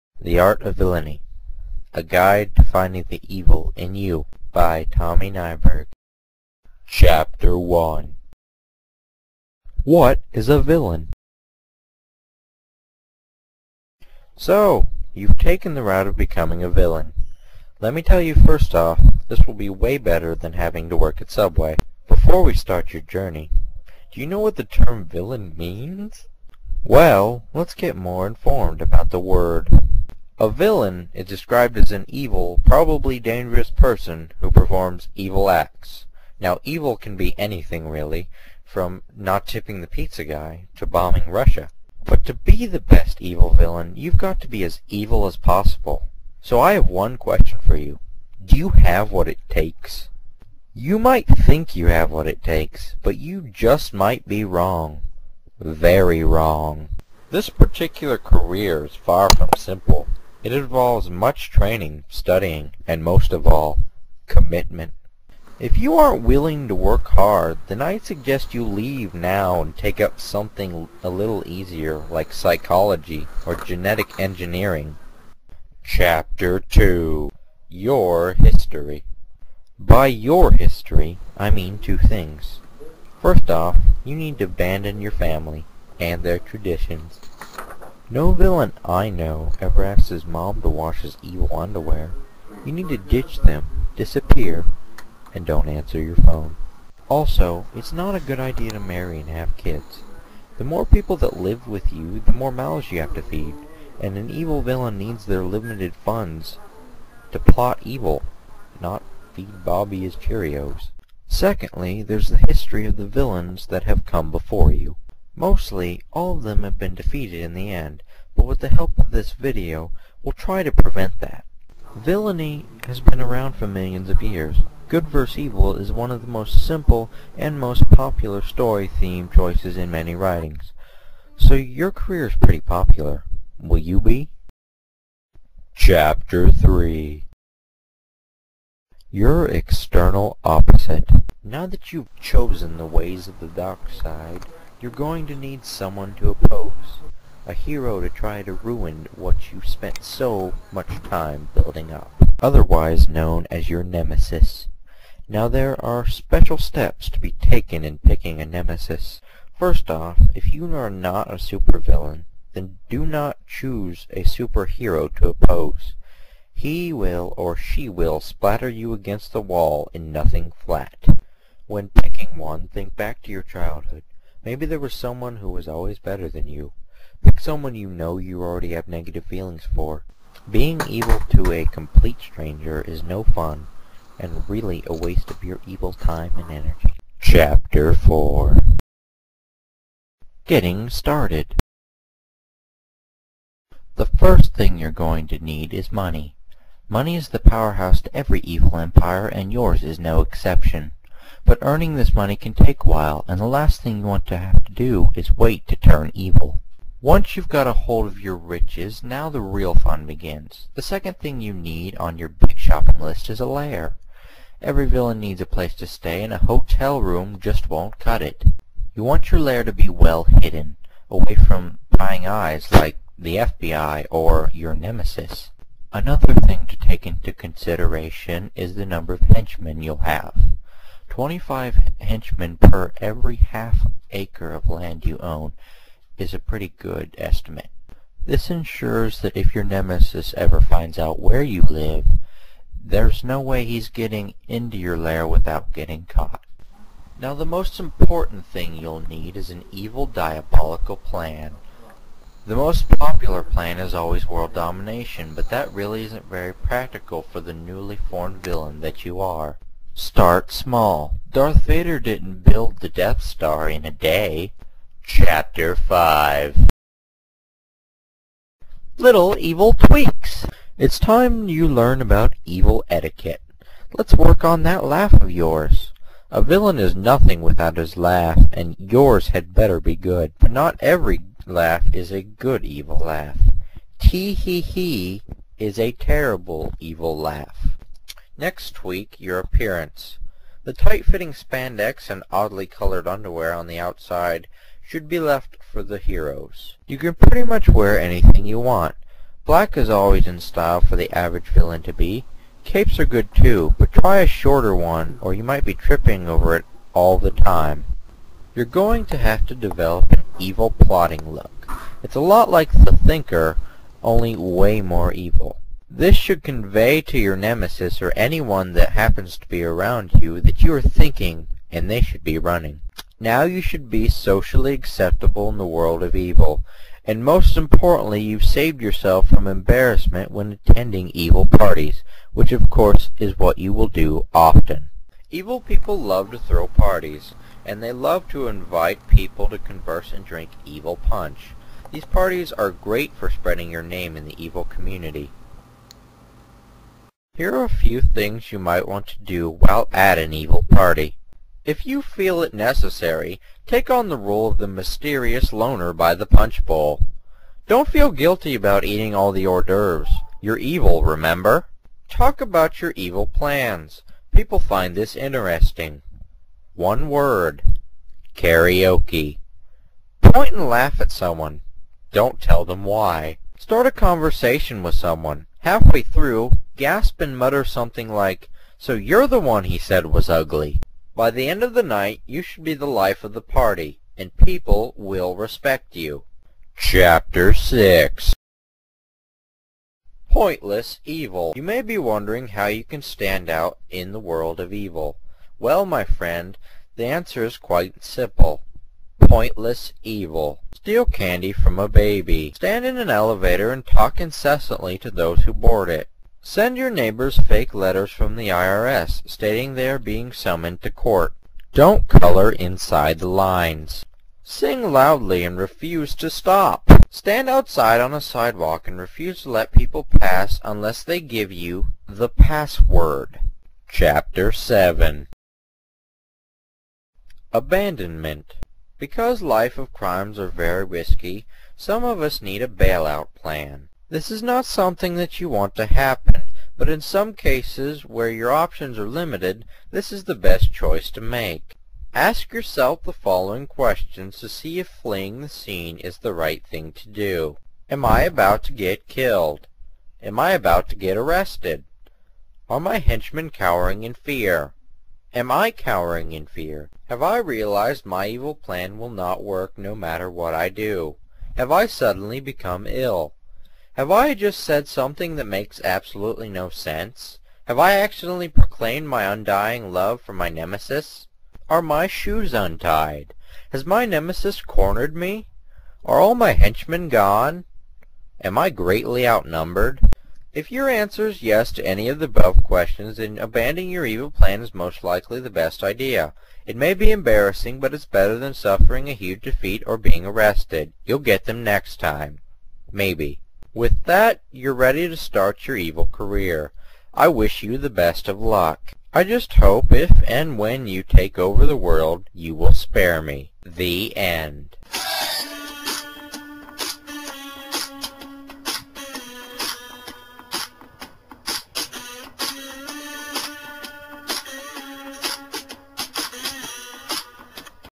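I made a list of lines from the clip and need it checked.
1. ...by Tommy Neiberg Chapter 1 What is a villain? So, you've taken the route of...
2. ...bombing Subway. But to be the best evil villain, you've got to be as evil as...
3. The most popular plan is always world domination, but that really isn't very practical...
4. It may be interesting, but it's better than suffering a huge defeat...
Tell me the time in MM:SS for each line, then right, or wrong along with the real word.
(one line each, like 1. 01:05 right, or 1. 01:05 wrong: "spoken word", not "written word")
1. 00:04 right
2. 00:40 wrong: "Russia", not "Subway"
3. 04:12 right
4. 08:06 wrong: "embarrassing", not "interesting".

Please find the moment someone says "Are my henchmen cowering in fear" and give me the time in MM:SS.
07:32.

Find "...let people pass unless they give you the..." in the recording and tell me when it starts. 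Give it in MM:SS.
06:59.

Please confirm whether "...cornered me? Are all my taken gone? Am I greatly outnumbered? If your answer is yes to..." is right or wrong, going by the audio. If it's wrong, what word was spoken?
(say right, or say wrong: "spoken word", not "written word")
wrong: "henchmen", not "taken".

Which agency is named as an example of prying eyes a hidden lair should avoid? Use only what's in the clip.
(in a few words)
FBI.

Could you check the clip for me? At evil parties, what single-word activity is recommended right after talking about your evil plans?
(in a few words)
Karaoke.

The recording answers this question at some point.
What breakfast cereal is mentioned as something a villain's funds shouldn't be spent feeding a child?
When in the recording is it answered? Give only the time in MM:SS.
01:50.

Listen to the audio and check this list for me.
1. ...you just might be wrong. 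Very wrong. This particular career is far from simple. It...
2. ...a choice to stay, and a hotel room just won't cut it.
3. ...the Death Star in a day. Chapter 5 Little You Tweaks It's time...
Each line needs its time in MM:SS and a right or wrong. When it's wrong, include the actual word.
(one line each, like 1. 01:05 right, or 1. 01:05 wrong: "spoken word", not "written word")
1. 00:53 right
2. 03:35 wrong: "place", not "choice"
3. 04:22 wrong: "Evil", not "You".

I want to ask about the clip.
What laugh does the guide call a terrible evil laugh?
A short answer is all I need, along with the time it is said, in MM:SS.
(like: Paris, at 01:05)
Tee-hee-hee, at 04:43.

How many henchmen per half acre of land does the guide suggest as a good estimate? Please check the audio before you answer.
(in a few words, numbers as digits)
25.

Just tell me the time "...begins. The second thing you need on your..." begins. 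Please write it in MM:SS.
03:30.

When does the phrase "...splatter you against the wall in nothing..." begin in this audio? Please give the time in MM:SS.
02:48.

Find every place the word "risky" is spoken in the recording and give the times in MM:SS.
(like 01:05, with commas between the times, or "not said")
07:10.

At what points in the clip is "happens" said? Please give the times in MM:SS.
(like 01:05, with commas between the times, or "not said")
05:18, 07:15.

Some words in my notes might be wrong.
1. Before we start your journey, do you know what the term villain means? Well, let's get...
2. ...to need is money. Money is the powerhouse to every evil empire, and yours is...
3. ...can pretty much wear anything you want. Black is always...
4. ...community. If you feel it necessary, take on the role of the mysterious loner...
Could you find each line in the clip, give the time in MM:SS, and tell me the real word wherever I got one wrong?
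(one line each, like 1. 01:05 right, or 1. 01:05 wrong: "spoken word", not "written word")
1. 00:22 right
2. 03:15 right
3. 04:56 right
4. 05:50 wrong: "party", not "community".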